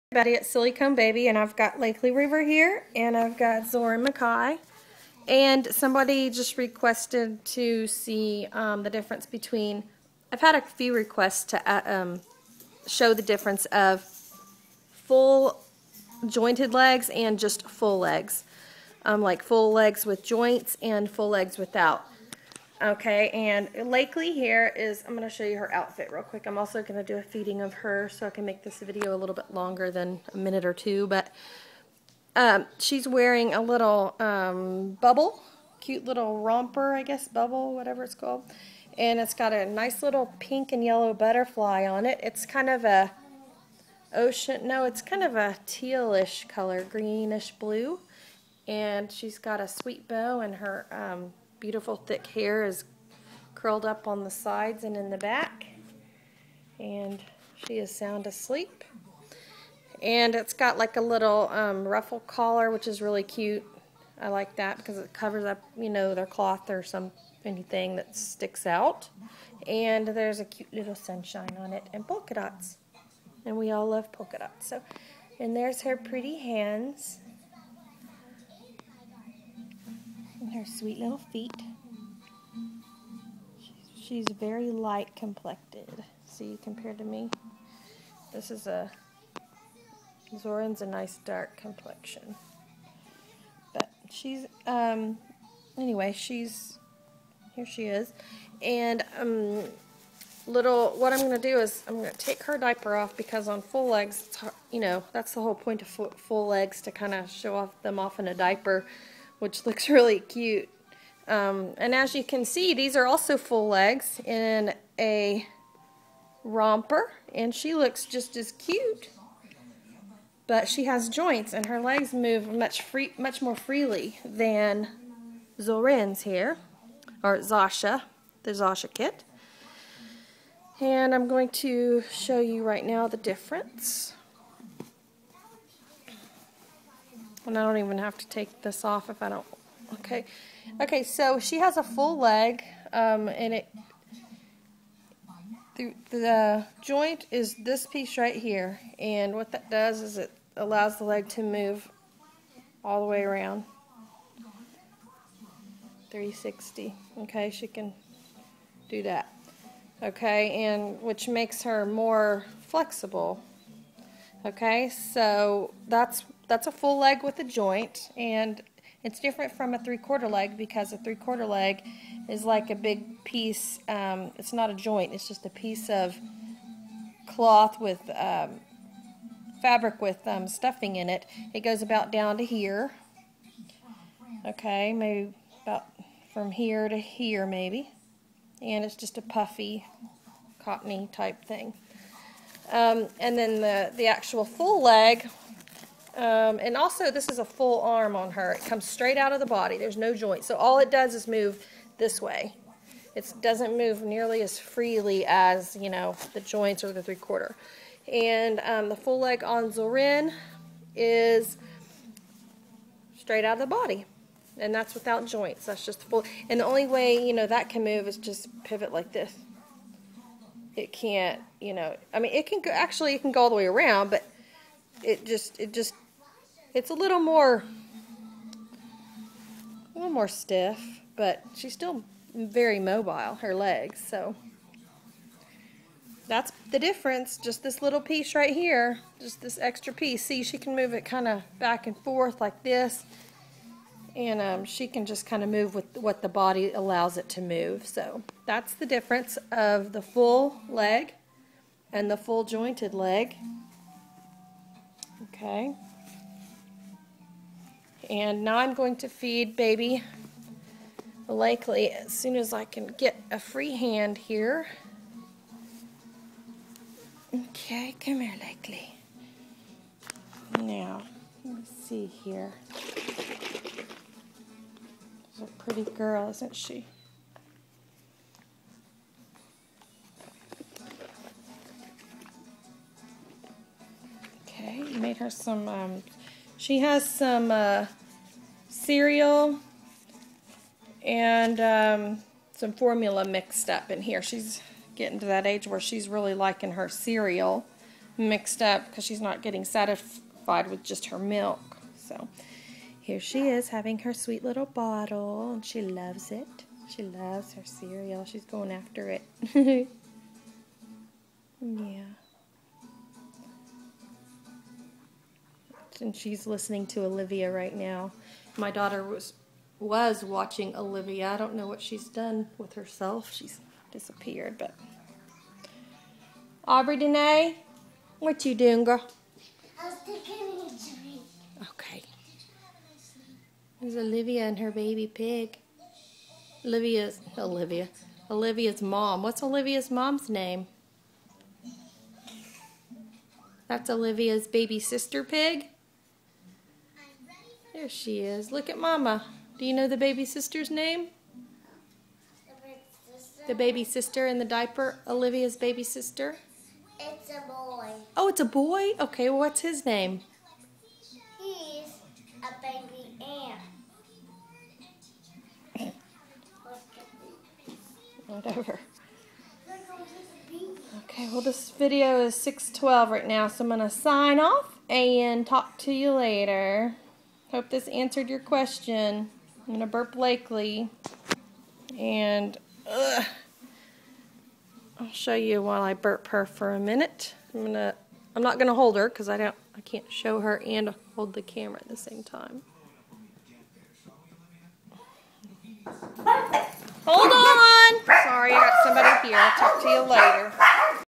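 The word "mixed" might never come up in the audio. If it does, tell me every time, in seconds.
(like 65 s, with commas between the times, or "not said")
293 s, 298 s.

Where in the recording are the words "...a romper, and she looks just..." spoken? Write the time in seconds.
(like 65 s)
114 s.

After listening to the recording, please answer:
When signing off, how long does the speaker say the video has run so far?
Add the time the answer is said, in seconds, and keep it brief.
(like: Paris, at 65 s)
6.12, at 372 s.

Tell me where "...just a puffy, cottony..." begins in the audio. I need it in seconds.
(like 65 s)
188 s.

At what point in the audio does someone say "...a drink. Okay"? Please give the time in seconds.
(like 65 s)
330 s.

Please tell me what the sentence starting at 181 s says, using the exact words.
It goes about down to here.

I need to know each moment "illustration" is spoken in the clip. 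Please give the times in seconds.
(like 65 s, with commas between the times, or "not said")
not said.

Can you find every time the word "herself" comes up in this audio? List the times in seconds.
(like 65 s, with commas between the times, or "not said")
322 s.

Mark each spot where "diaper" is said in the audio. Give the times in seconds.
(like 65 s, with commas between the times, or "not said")
102 s, 108 s, 354 s.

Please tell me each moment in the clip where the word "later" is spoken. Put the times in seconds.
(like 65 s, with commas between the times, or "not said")
376 s, 400 s.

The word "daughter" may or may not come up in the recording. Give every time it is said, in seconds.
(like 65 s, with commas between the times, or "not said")
318 s.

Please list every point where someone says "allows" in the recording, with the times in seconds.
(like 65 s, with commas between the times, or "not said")
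150 s, 246 s.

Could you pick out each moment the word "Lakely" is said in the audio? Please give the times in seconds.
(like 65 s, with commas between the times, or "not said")
1 s, 23 s, 261 s, 268 s, 380 s.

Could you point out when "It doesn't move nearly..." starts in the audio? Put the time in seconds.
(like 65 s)
203 s.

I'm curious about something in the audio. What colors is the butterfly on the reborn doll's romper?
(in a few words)
Pink and yellow.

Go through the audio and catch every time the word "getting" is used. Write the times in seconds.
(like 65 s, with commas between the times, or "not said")
294 s, 299 s.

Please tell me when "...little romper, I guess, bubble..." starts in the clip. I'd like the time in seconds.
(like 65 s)
36 s.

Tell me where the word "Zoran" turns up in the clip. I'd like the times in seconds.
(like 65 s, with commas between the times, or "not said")
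3 s, 90 s.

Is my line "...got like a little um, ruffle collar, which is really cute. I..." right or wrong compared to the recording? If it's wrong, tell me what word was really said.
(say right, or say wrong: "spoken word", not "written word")
right.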